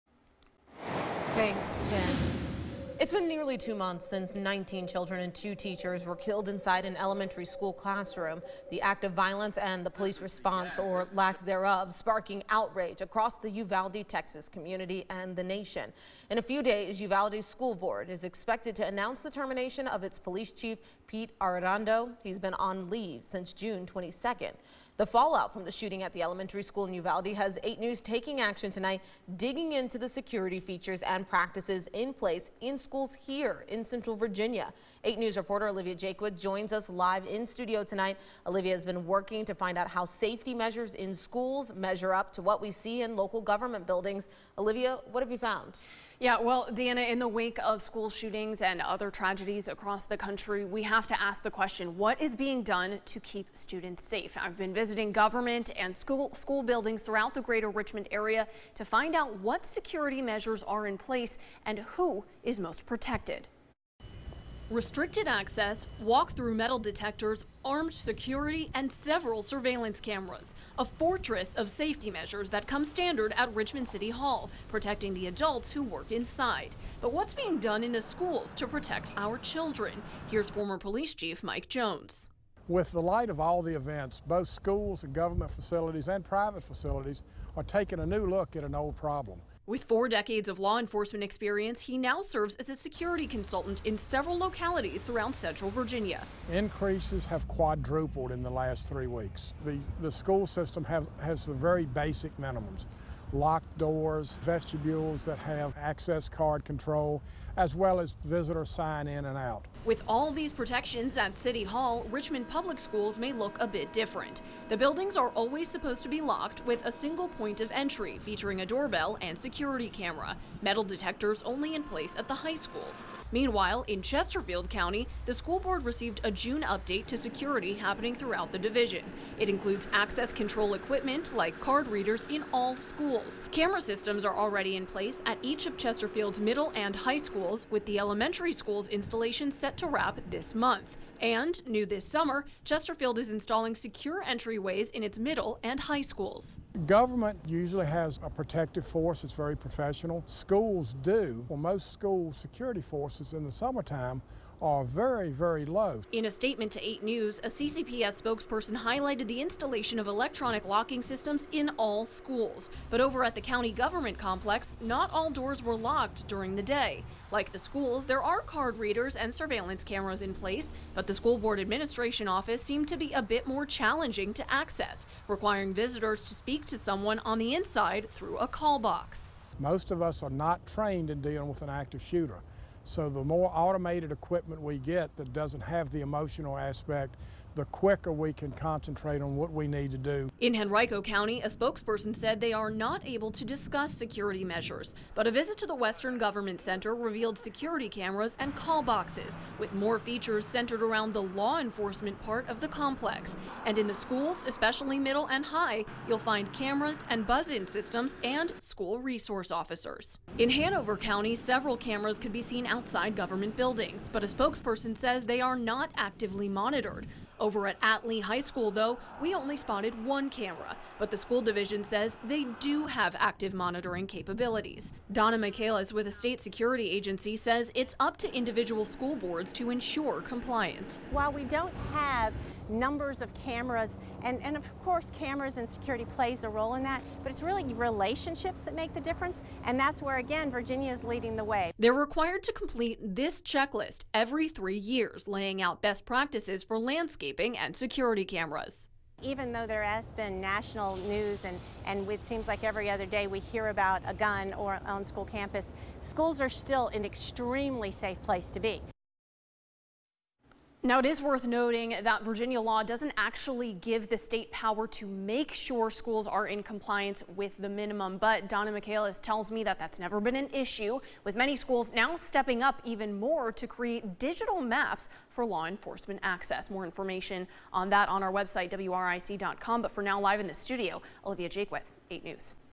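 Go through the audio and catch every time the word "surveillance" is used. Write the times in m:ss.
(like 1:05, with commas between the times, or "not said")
1:09, 2:49.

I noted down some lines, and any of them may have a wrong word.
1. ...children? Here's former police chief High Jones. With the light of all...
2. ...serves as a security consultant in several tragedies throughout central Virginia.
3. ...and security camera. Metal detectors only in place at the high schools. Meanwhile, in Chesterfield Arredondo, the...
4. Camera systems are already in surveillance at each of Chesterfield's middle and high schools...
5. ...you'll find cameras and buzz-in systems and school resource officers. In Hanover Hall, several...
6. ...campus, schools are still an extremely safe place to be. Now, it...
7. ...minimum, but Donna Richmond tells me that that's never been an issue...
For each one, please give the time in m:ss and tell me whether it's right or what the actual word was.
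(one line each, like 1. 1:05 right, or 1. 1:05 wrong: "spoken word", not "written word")
1. 1:19 wrong: "Mike", not "High"
2. 1:32 wrong: "localities", not "tragedies"
3. 1:59 wrong: "County", not "Arredondo"
4. 2:13 wrong: "place", not "surveillance"
5. 3:26 wrong: "County", not "Hall"
6. 4:15 right
7. 4:27 wrong: "Michaelis", not "Richmond".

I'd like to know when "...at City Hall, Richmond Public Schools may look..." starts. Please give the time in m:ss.
1:51.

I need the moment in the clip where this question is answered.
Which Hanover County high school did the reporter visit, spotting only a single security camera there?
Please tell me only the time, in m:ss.
3:37.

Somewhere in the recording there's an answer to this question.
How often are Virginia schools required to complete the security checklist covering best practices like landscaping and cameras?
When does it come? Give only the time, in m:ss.
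4:04.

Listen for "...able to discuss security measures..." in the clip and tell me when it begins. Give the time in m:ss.
3:13.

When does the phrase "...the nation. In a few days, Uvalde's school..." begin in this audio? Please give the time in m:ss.
0:15.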